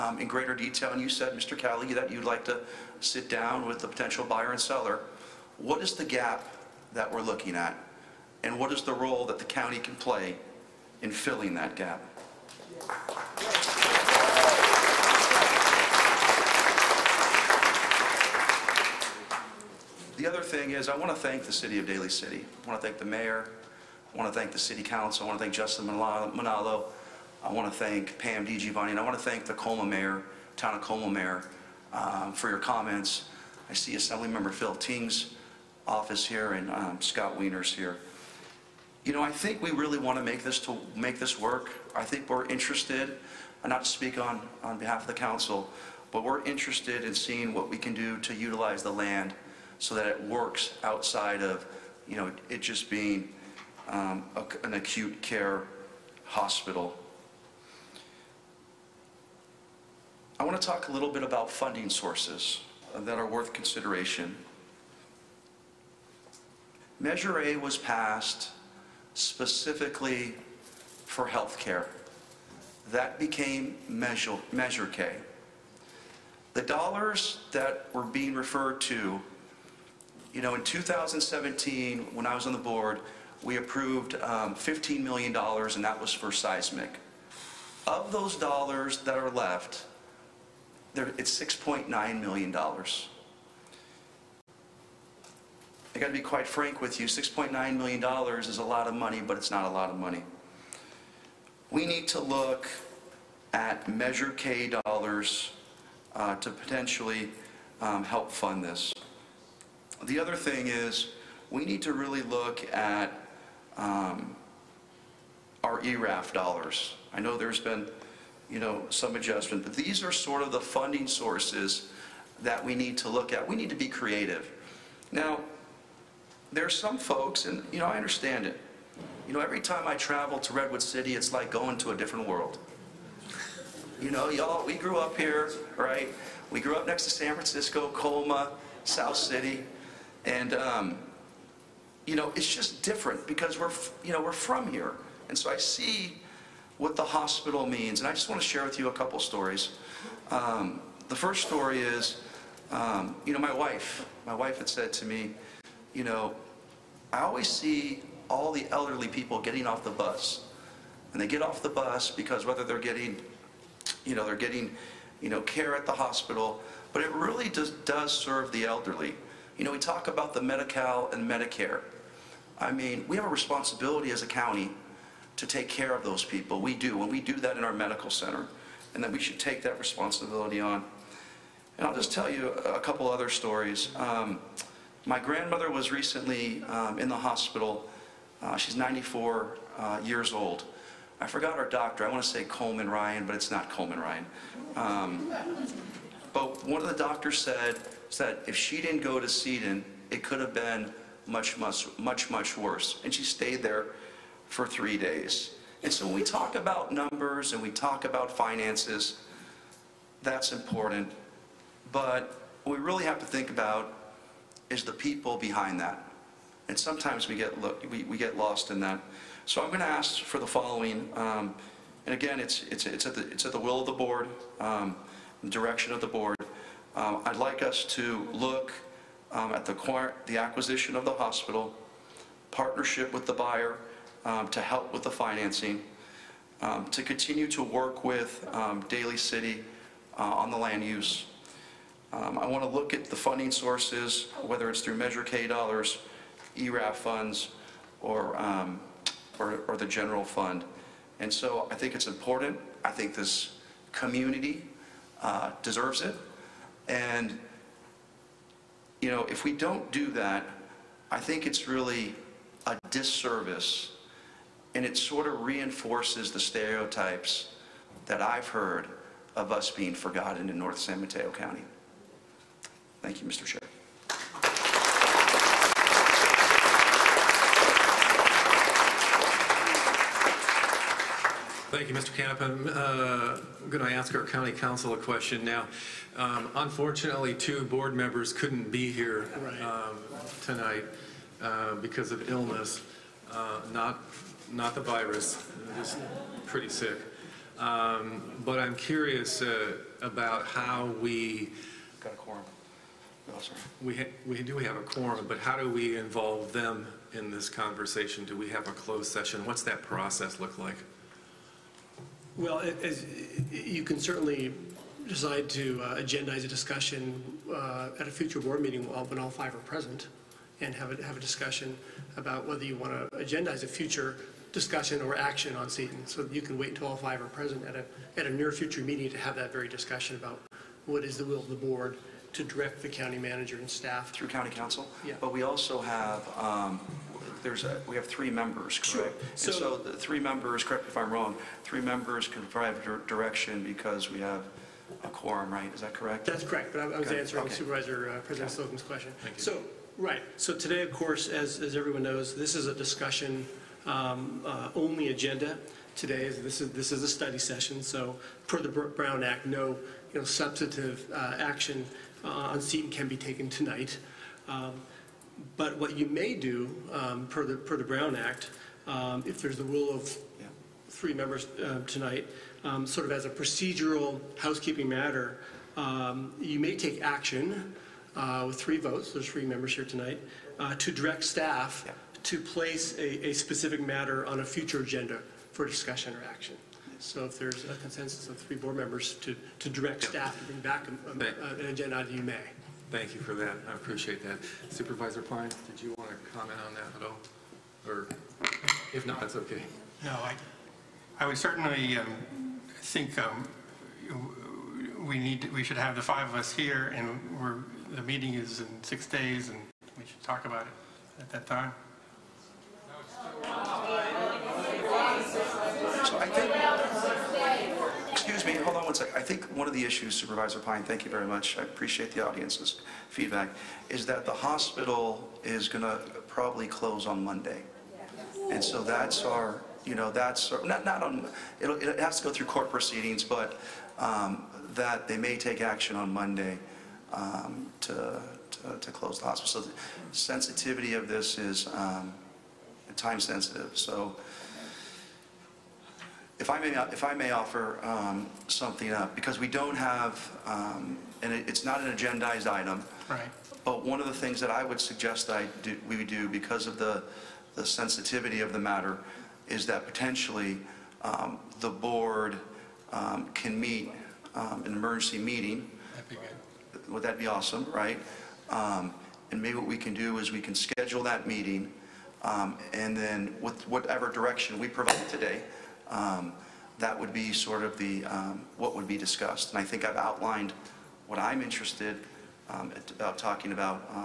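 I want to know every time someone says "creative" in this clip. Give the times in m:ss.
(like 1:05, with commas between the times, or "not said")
2:03.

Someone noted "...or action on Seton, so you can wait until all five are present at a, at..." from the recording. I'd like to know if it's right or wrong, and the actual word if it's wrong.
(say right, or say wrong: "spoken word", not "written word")
right.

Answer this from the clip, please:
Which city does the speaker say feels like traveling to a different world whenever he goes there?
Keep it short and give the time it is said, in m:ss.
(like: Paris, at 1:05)
Redwood City, at 2:10.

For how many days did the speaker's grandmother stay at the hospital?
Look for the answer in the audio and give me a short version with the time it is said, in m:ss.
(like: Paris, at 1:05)
3, at 3:24.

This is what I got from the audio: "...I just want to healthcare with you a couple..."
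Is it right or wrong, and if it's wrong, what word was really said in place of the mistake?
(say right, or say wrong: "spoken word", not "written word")
wrong: "share", not "healthcare".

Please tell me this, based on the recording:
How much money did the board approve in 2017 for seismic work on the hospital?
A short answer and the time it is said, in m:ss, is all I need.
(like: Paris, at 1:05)
$15 million, at 1:24.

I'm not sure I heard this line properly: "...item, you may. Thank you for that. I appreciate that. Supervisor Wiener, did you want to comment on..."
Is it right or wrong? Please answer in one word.
wrong.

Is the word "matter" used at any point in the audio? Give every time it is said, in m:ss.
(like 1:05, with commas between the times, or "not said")
6:14, 6:23, 7:38.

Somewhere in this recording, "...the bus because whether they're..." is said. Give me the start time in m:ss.
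2:41.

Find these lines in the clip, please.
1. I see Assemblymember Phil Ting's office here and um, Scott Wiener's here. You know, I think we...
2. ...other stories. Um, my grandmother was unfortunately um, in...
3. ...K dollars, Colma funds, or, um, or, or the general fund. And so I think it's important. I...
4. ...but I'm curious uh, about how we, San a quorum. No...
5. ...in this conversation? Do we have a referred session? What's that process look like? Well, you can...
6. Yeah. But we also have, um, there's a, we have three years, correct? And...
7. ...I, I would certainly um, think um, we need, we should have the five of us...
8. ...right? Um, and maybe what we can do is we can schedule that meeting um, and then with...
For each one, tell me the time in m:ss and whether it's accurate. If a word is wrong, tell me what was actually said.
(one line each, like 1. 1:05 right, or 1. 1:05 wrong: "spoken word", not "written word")
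1. 0:33 right
2. 3:03 wrong: "recently", not "unfortunately"
3. 4:05 wrong: "ERAF", not "Colma"
4. 4:58 wrong: "Got", not "San"
5. 5:07 wrong: "closed", not "referred"
6. 5:35 wrong: "members", not "years"
7. 6:40 right
8. 7:47 right.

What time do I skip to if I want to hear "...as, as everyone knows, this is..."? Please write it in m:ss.
5:51.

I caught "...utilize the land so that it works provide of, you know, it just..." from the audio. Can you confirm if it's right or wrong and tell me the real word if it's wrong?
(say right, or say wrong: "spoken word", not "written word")
wrong: "outside", not "provide".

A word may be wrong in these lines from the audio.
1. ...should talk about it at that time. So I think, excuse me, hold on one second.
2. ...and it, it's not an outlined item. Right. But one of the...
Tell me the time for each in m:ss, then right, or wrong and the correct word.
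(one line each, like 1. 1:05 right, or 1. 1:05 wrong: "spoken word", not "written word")
1. 6:50 right
2. 7:31 wrong: "agendized", not "outlined".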